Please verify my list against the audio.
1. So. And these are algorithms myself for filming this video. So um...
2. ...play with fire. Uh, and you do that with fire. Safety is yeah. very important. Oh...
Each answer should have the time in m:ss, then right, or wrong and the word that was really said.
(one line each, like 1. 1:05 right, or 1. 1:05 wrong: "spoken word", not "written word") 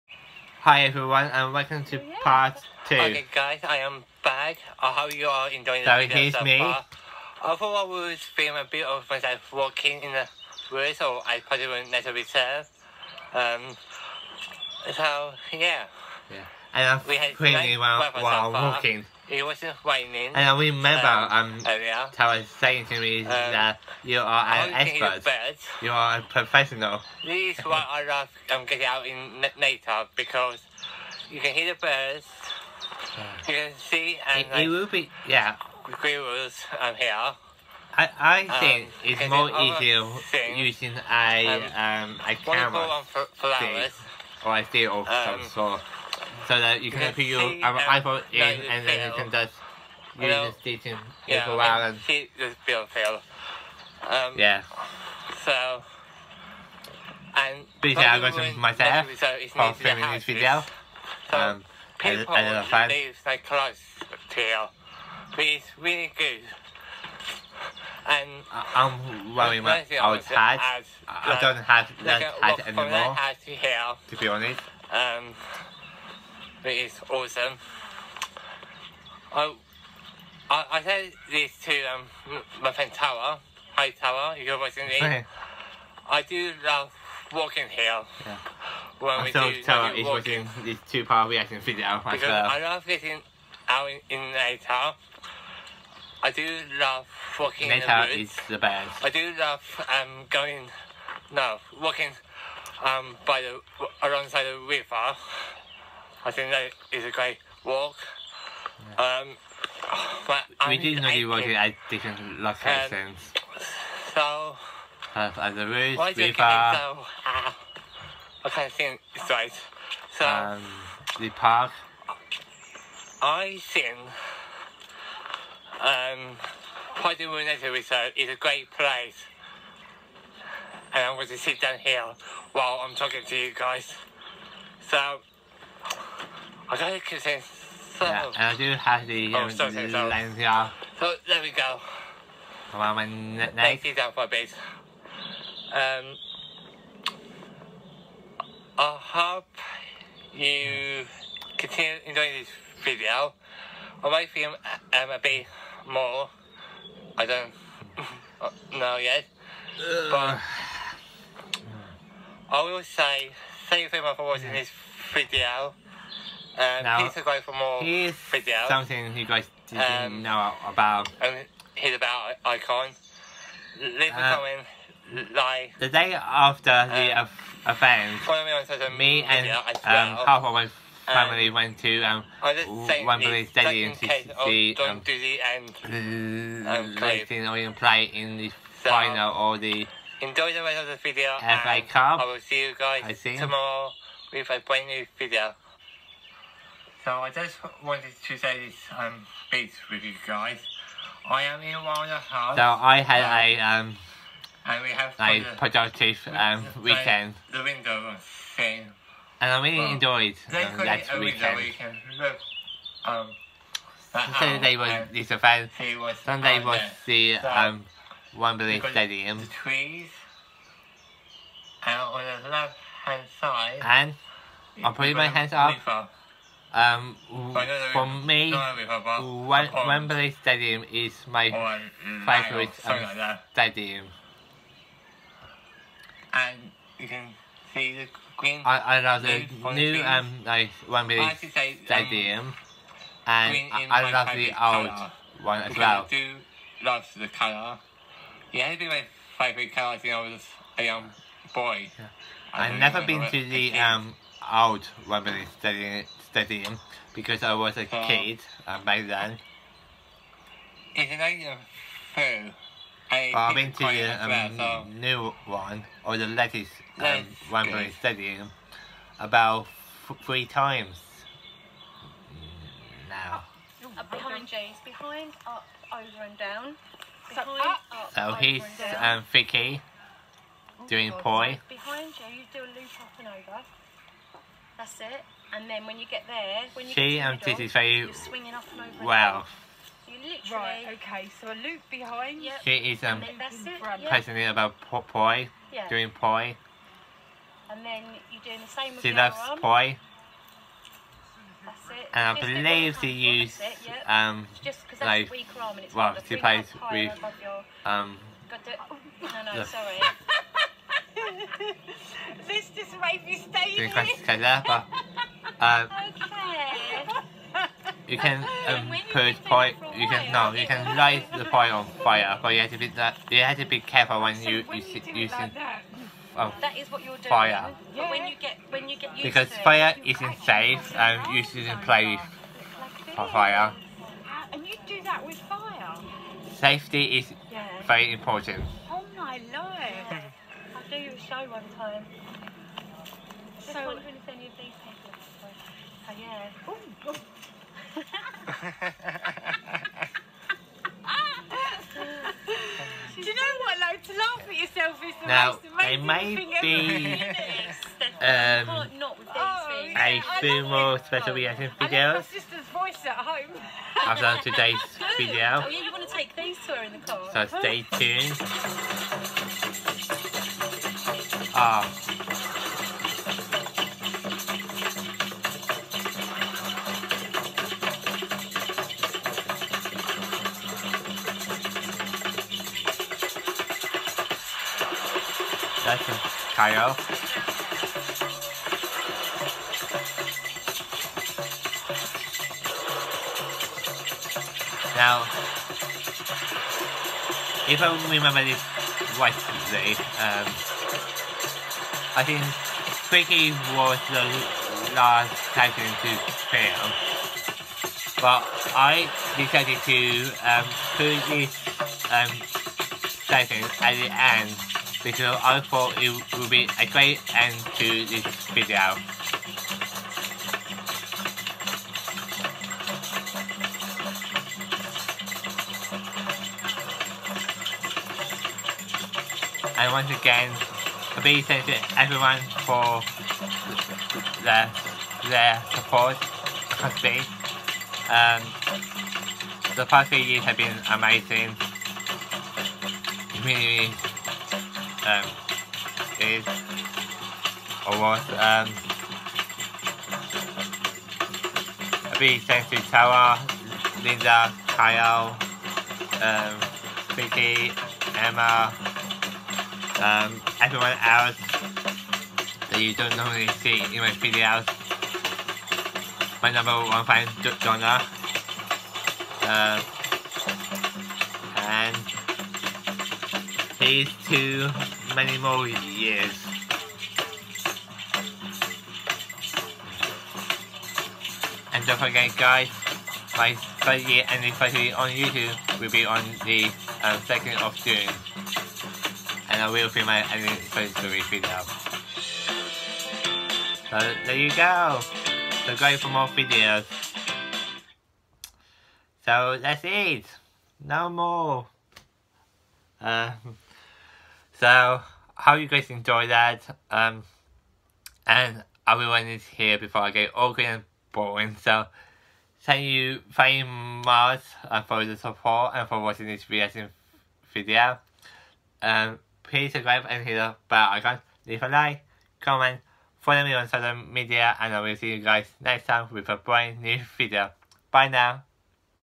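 1. 0:55 right
2. 5:31 right.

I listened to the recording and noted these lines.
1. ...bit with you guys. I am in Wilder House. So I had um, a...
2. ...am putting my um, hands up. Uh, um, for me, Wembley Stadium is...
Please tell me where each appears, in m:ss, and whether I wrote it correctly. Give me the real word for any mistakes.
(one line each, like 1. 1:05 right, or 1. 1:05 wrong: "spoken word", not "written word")
1. 3:19 right
2. 3:44 right.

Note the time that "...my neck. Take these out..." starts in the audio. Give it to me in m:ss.
2:22.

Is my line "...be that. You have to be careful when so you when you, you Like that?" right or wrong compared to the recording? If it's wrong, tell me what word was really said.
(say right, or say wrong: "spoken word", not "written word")
right.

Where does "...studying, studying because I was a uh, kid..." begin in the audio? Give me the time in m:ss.
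4:15.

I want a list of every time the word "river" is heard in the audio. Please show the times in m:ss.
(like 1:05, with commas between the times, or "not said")
1:44, 1:55.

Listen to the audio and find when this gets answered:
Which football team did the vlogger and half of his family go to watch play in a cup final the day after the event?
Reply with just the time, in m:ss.
3:07.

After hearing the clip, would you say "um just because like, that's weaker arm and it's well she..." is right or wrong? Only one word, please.
right.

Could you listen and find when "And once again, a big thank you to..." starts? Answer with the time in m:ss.
7:09.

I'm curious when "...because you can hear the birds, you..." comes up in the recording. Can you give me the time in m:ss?
0:30.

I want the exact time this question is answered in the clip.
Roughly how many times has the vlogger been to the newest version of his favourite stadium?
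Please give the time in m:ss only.
4:30.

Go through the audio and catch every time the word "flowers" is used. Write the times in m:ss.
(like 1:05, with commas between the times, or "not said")
0:43.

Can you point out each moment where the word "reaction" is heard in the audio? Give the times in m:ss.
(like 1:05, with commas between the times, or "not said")
1:31, 6:01, 8:36.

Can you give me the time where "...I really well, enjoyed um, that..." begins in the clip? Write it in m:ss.
3:29.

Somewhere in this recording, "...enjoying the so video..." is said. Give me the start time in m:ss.
0:05.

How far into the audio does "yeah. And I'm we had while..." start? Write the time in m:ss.
0:16.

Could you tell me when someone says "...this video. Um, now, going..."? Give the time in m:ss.
2:44.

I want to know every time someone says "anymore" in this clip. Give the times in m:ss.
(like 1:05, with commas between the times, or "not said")
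1:12.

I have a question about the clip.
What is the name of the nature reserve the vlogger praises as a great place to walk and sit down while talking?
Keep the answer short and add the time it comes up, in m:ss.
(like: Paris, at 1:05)
Paddy Muneta Reserve, at 2:06.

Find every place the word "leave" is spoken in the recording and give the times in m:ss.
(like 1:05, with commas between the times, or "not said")
2:53, 8:41.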